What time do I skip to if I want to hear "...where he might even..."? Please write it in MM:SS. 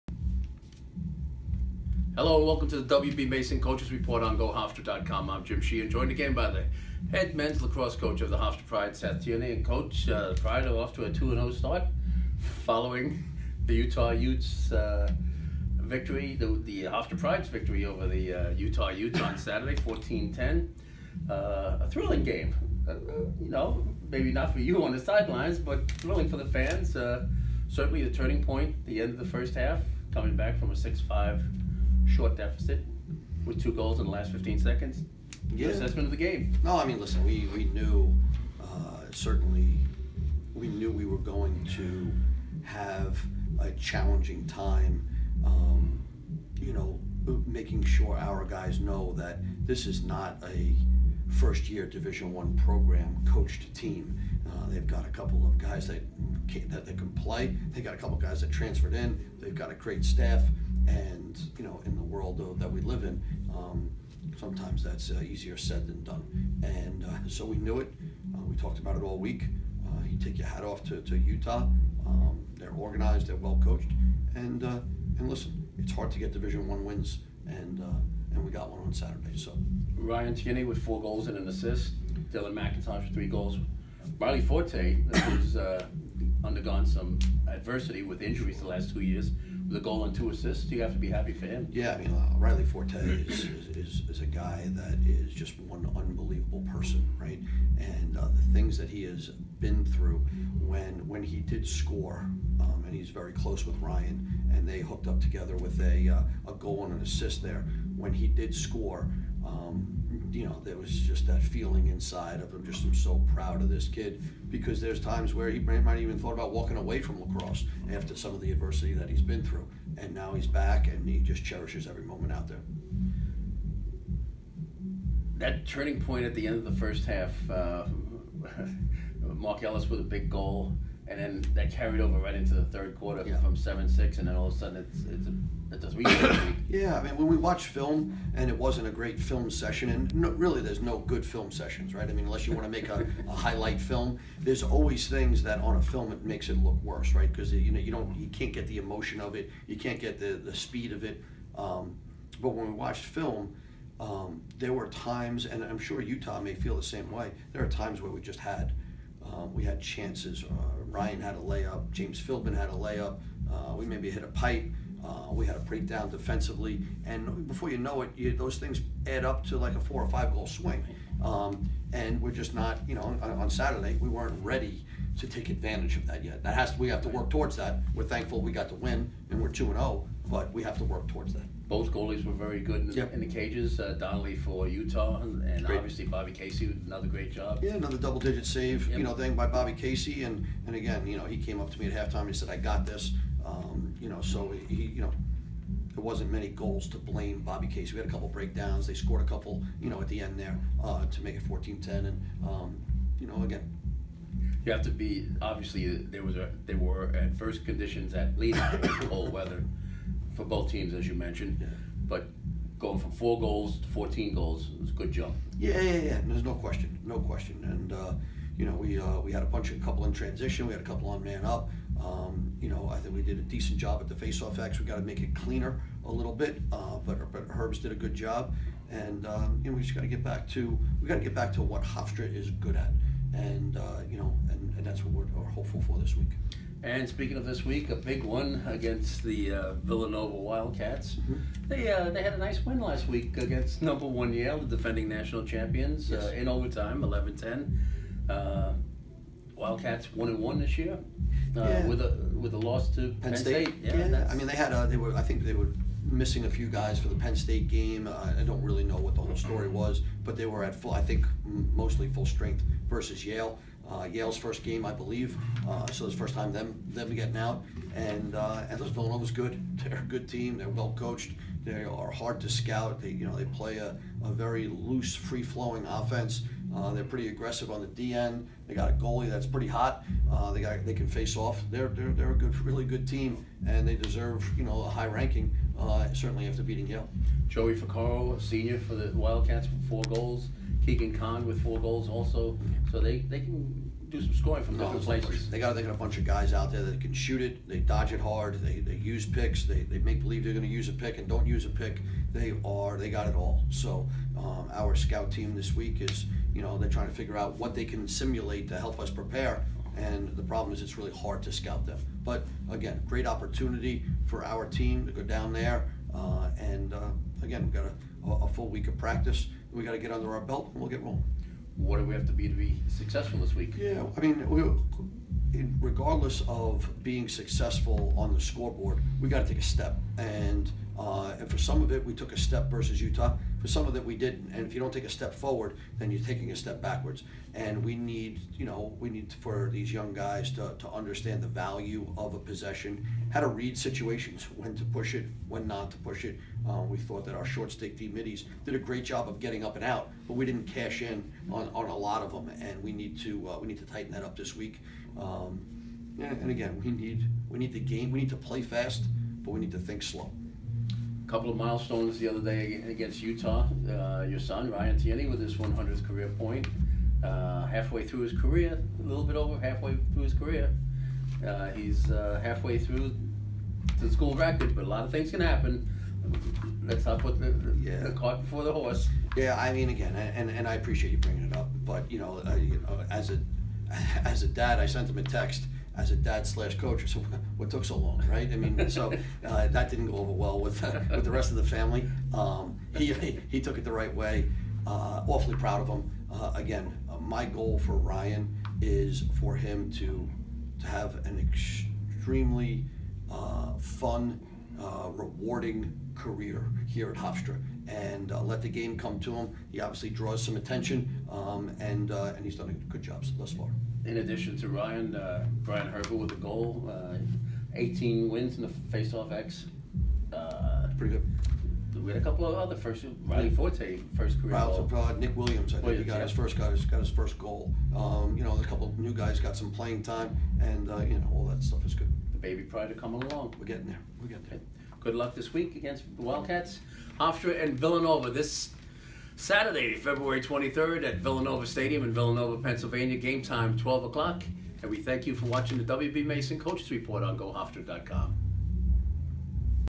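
01:55.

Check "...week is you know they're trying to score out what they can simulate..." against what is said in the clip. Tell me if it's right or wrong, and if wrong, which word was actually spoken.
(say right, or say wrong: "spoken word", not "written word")
wrong: "figure", not "score".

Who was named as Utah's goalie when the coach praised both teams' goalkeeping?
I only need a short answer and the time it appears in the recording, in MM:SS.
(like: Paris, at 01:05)
Donnelly, at 03:03.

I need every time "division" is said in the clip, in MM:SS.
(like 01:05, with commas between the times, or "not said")
00:51, 01:16.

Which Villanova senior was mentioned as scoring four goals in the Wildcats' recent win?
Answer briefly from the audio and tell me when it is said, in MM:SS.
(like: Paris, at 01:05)
Joey Ficaro, at 04:47.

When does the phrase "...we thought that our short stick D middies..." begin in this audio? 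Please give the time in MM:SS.
05:46.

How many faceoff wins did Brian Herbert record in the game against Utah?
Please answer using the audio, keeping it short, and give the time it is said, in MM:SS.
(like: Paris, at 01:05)
18, at 06:57.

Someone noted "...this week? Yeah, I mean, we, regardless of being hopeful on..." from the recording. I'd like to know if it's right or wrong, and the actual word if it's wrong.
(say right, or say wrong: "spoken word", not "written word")
wrong: "successful", not "hopeful".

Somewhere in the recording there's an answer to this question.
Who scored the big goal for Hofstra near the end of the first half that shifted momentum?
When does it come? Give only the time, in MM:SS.
02:09.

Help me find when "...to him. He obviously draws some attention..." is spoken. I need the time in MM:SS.
06:49.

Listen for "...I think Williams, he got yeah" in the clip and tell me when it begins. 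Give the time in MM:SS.
07:05.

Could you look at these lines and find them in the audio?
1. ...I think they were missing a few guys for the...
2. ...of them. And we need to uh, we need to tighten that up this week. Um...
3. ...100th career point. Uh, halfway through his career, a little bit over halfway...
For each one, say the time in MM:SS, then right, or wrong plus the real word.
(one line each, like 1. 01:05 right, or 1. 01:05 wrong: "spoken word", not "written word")
1. 04:15 right
2. 05:52 right
3. 06:05 right.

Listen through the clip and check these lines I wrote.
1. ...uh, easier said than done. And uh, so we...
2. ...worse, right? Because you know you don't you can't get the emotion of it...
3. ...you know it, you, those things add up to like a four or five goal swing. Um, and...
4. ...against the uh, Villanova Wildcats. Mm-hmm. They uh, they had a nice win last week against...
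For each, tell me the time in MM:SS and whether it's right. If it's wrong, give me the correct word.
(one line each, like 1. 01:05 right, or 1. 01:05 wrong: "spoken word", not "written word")
1. 01:05 right
2. 02:26 right
3. 02:47 right
4. 03:58 right.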